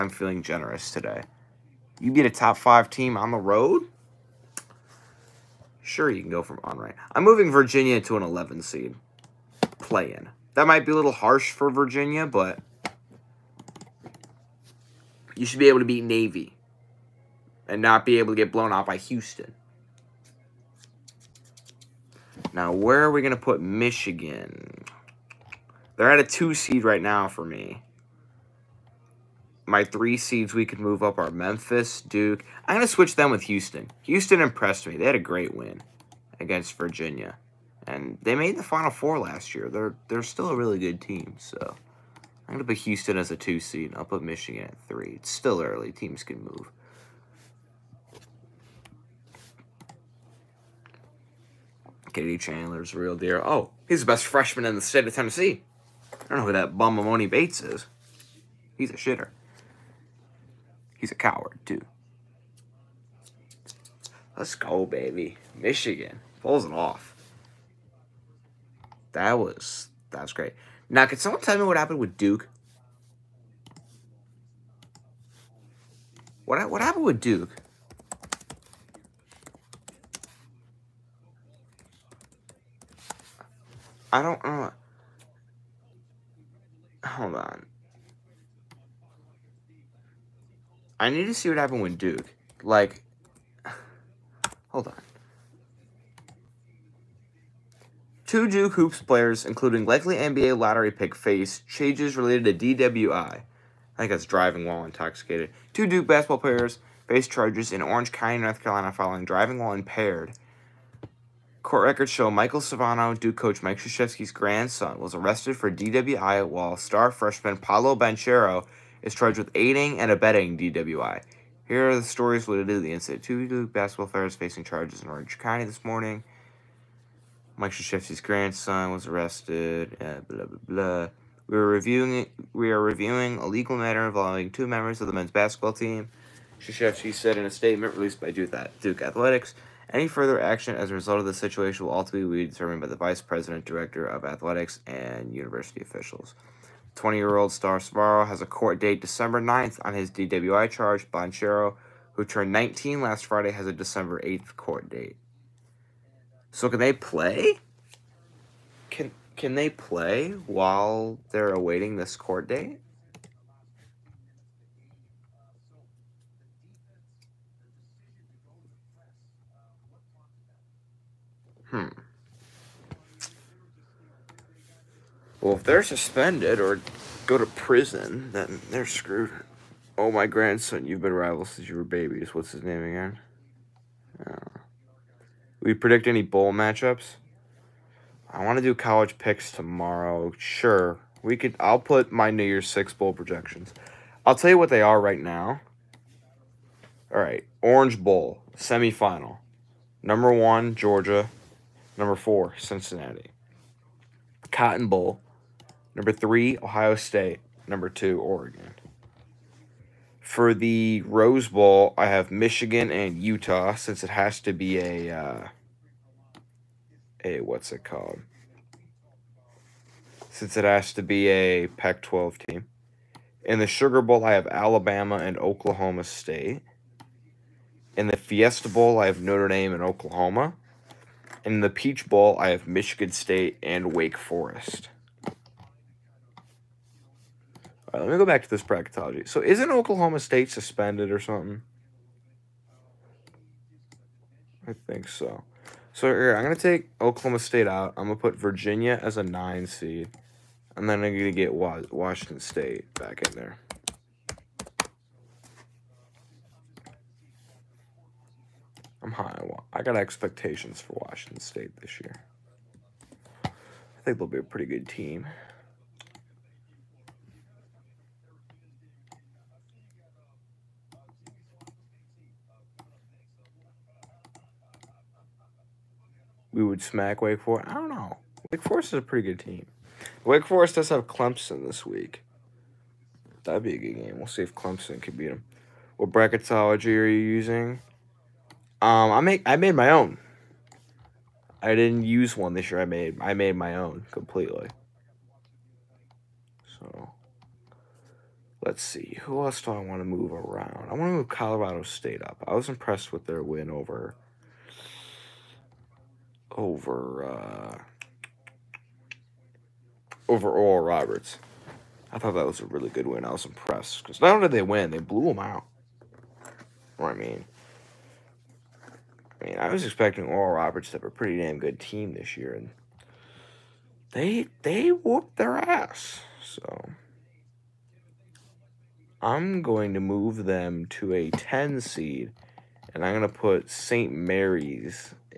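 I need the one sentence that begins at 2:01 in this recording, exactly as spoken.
Here are the stories related to the incident.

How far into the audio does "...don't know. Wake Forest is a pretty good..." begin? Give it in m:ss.
4:37.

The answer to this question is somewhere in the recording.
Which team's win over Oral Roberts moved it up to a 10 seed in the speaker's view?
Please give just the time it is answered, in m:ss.
5:01.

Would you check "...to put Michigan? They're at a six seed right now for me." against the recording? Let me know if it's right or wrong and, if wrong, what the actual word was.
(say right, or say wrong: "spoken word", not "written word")
wrong: "two", not "six".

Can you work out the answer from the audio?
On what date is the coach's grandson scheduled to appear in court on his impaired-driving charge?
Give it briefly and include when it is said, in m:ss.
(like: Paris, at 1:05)
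December 9th, at 2:28.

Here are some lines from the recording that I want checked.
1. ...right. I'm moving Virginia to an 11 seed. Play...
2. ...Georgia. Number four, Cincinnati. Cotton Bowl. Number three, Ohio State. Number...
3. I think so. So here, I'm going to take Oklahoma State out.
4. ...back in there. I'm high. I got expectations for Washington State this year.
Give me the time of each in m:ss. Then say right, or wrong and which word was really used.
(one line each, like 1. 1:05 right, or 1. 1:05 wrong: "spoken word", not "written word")
1. 0:06 right
2. 3:20 right
3. 4:04 right
4. 4:12 right.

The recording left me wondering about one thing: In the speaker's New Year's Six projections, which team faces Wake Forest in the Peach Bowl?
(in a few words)
Michigan State.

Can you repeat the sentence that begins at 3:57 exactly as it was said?
All right, let me go back to this bracketology.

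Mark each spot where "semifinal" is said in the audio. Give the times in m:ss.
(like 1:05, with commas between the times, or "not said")
3:18.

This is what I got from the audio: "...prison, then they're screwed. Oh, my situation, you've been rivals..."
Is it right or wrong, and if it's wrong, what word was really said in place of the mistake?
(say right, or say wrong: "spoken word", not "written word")
wrong: "grandson", not "situation".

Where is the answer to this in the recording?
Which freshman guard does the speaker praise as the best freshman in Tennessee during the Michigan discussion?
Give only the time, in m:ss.
0:52.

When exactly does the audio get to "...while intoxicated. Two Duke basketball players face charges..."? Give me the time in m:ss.
1:44.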